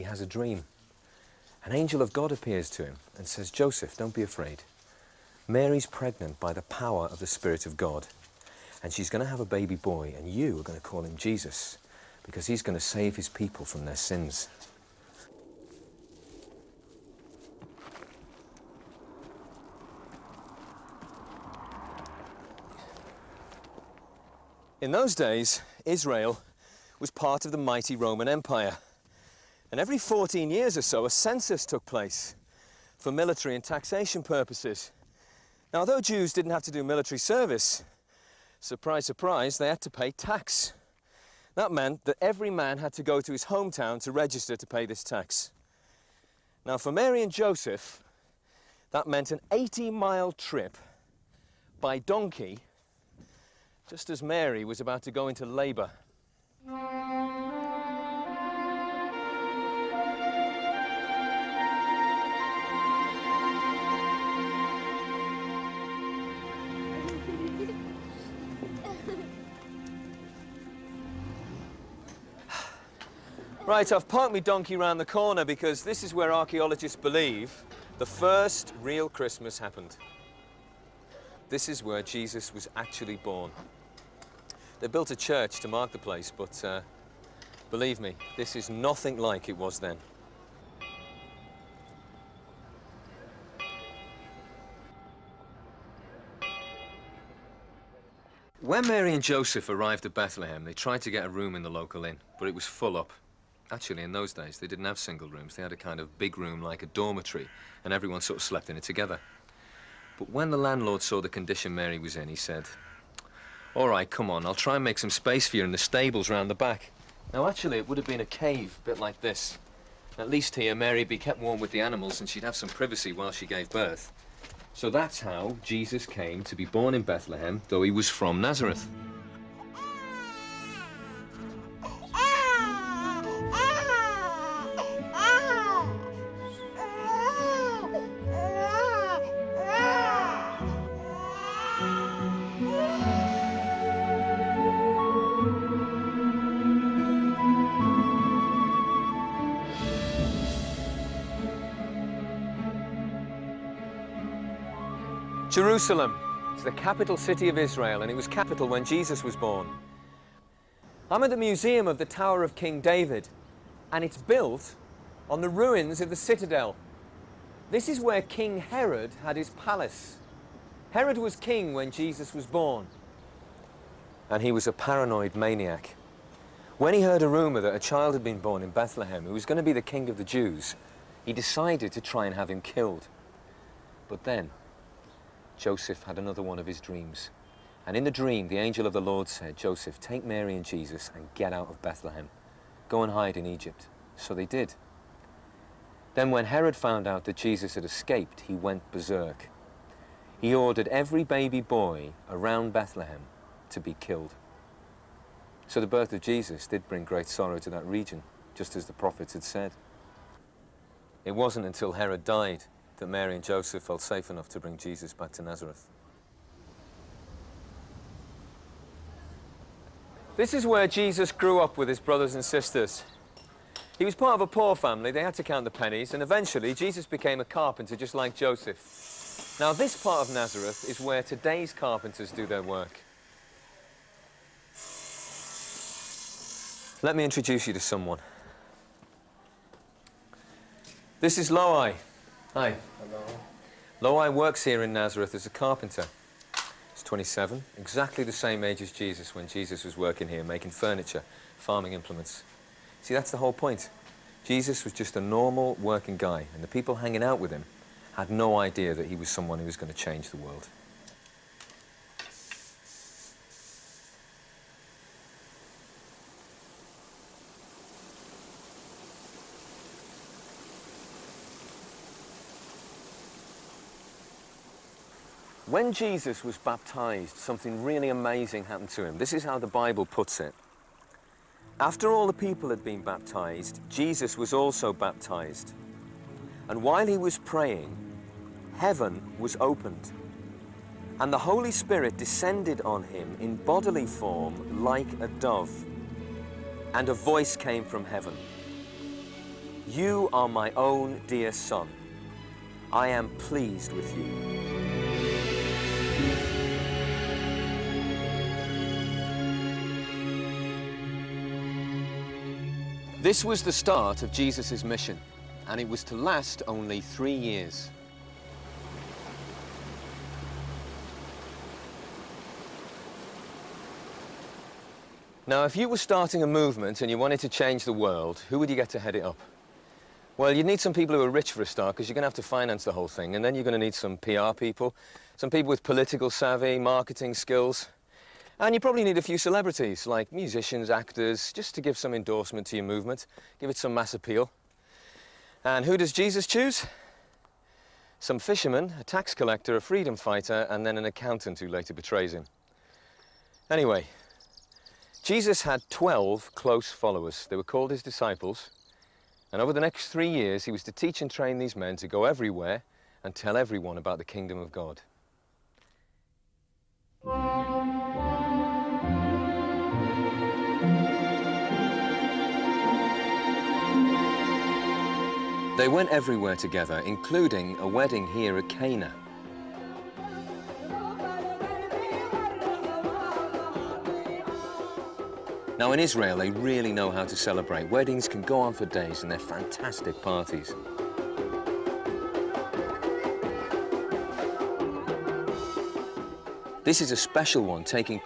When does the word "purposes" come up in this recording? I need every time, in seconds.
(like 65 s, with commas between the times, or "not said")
34 s.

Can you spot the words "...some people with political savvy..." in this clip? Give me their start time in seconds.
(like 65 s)
335 s.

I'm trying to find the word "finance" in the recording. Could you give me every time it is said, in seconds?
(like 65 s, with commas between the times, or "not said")
332 s.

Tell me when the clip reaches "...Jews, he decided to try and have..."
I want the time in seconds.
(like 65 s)
180 s.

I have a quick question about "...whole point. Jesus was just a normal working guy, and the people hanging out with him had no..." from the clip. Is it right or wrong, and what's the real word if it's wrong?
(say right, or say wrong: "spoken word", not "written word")
right.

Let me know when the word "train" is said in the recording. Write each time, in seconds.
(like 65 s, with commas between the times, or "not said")
361 s.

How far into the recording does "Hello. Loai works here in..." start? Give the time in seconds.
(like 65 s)
242 s.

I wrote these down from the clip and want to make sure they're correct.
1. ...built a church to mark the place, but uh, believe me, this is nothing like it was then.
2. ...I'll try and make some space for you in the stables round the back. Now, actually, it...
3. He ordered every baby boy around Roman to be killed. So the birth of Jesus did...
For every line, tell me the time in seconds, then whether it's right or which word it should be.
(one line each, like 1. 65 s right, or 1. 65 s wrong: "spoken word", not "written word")
1. 84 s right
2. 114 s right
3. 200 s wrong: "Bethlehem", not "Roman".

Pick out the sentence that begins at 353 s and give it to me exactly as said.
Anyway, Jesus had 12 close followers.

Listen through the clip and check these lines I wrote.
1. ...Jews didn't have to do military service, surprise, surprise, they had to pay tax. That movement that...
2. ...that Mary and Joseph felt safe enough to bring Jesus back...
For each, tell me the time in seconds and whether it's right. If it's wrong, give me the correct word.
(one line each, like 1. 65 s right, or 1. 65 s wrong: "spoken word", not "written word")
1. 36 s wrong: "meant", not "movement"
2. 212 s right.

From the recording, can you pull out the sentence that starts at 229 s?
Now this part of Nazareth is where today's carpenters do their work.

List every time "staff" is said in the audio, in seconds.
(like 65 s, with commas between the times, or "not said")
not said.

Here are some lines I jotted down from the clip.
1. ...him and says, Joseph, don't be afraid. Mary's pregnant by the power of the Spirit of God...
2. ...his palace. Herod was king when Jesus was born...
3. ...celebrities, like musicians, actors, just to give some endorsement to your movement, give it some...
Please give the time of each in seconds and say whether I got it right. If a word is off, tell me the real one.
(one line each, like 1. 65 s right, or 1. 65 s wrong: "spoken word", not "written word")
1. 2 s right
2. 169 s right
3. 339 s right.